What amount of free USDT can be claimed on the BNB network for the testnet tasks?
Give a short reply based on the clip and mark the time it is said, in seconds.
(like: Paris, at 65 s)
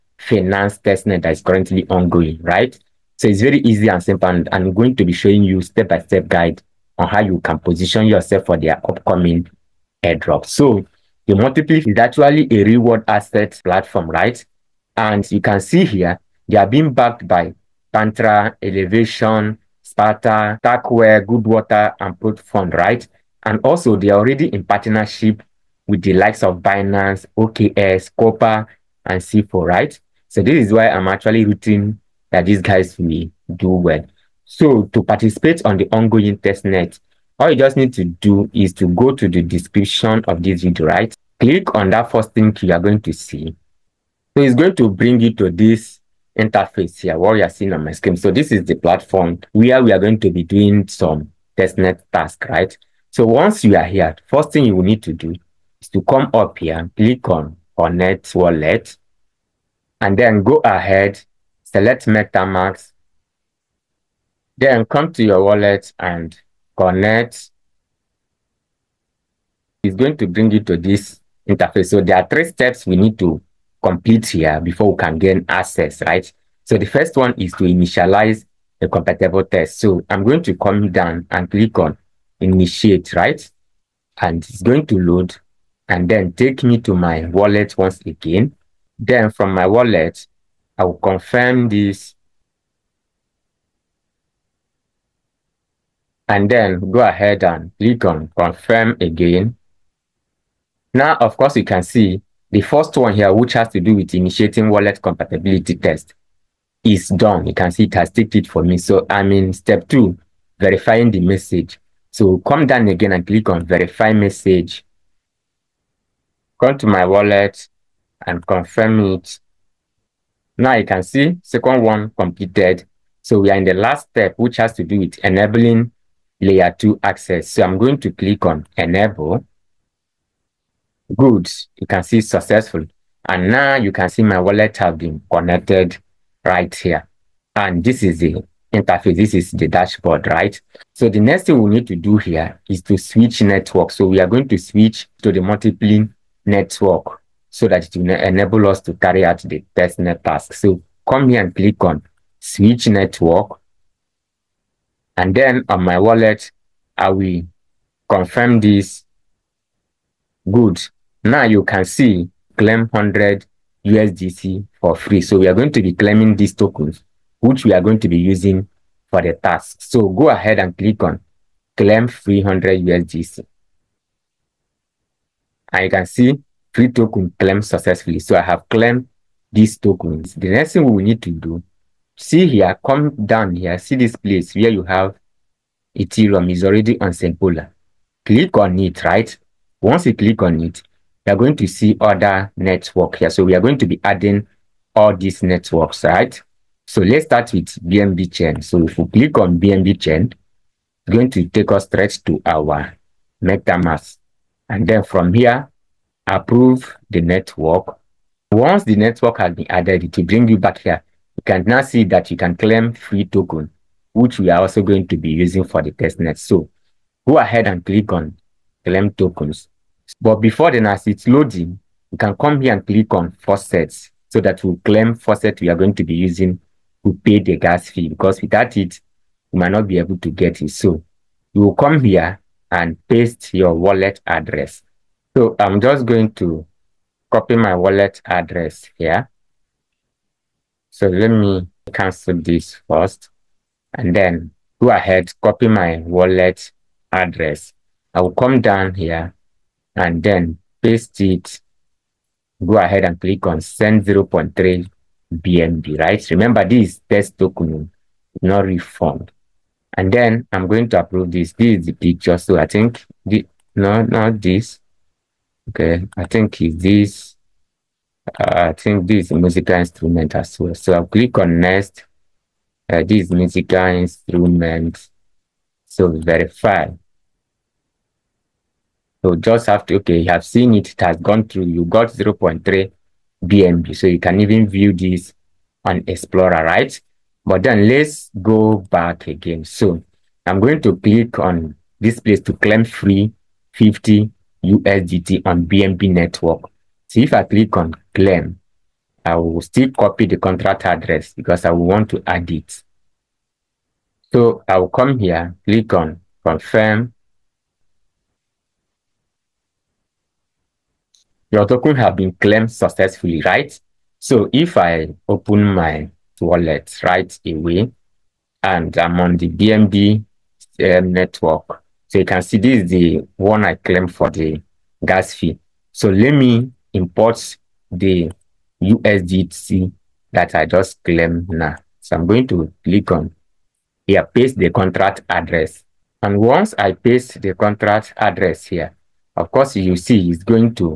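50 USDT, at 293 s.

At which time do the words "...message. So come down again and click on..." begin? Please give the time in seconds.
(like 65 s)
111 s.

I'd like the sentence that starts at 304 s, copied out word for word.
So I will come here, click on confirm your token have been claimed successfully, right?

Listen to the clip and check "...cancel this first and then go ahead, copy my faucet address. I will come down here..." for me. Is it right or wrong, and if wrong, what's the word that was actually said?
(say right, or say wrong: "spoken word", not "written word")
wrong: "wallet", not "faucet".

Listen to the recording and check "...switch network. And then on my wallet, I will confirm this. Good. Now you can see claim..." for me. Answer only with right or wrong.
right.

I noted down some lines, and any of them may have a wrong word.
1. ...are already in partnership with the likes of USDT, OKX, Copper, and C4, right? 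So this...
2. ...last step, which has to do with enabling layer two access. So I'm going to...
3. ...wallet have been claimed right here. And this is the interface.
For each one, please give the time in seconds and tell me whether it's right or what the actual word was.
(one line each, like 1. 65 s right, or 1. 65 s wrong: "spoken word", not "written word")
1. 24 s wrong: "Binance", not "USDT"
2. 123 s right
3. 134 s wrong: "connected", not "claimed".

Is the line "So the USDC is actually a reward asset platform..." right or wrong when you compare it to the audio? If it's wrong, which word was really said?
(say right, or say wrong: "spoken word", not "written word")
wrong: "Multipli", not "USDC".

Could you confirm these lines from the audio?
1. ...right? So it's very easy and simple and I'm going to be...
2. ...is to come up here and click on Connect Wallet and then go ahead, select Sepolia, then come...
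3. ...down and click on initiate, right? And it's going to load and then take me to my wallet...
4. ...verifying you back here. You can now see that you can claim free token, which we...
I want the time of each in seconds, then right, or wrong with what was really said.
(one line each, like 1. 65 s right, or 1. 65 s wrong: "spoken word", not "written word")
1. 2 s right
2. 55 s wrong: "MetaMask", not "Sepolia"
3. 80 s right
4. 210 s wrong: "bring", not "verifying".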